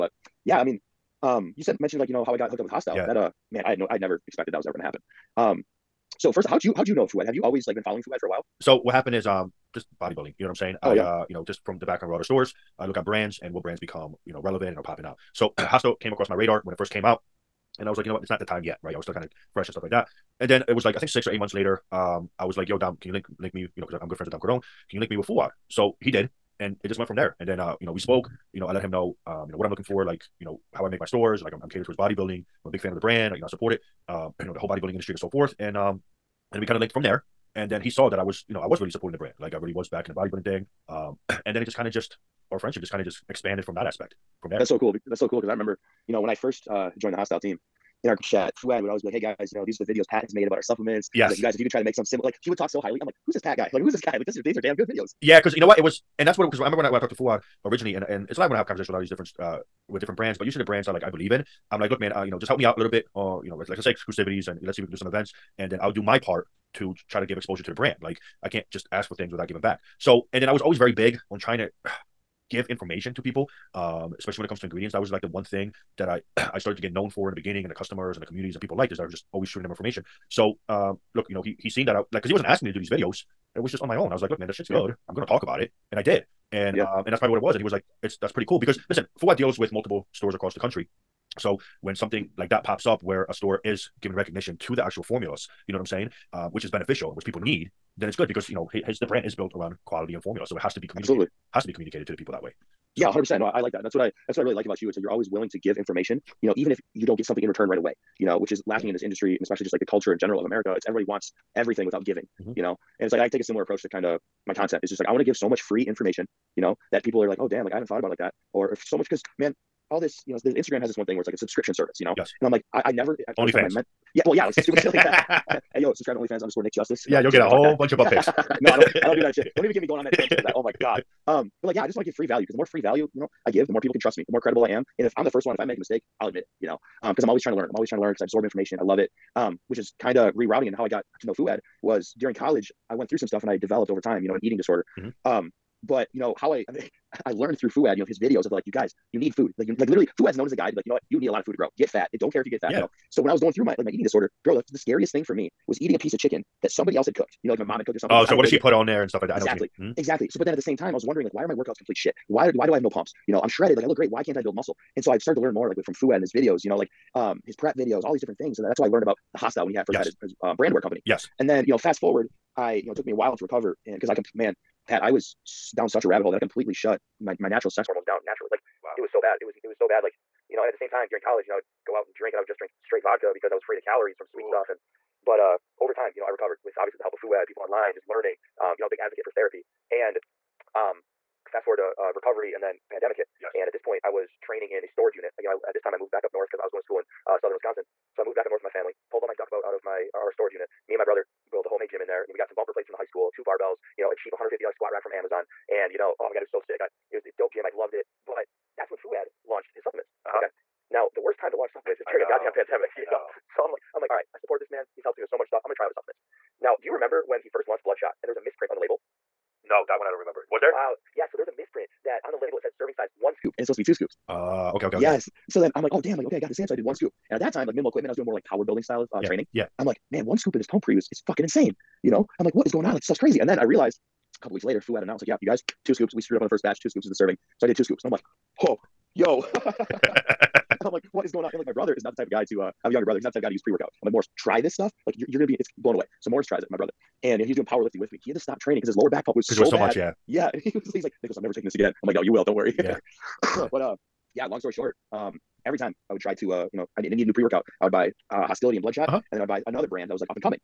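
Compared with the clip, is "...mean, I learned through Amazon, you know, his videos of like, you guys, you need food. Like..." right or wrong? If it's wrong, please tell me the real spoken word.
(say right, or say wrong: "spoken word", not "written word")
wrong: "Fouad", not "Amazon".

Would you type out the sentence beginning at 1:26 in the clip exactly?
um, and that's probably what it was.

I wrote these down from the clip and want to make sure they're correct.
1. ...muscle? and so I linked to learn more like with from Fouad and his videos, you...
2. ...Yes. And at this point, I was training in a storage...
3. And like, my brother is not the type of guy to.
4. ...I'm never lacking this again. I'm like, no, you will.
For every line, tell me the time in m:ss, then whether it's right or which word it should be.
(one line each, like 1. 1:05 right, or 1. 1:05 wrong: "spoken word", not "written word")
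1. 2:44 wrong: "started", not "linked"
2. 3:13 right
3. 4:01 right
4. 4:11 wrong: "taking", not "lacking".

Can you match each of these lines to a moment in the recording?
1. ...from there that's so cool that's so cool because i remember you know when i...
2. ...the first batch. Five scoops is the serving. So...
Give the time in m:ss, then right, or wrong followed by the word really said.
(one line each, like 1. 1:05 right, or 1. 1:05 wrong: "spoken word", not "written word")
1. 0:44 right
2. 3:56 wrong: "Two", not "Five".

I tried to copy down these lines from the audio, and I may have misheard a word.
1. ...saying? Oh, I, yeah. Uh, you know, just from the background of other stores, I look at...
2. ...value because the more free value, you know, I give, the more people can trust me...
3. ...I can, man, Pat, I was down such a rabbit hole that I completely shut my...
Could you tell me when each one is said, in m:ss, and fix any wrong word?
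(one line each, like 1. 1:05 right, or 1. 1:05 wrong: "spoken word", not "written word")
1. 0:10 right
2. 2:12 right
3. 2:54 right.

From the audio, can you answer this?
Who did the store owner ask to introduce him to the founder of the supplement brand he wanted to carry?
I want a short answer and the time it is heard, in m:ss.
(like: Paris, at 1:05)
Dom Cordone, at 0:24.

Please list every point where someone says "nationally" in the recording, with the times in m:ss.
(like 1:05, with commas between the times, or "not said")
not said.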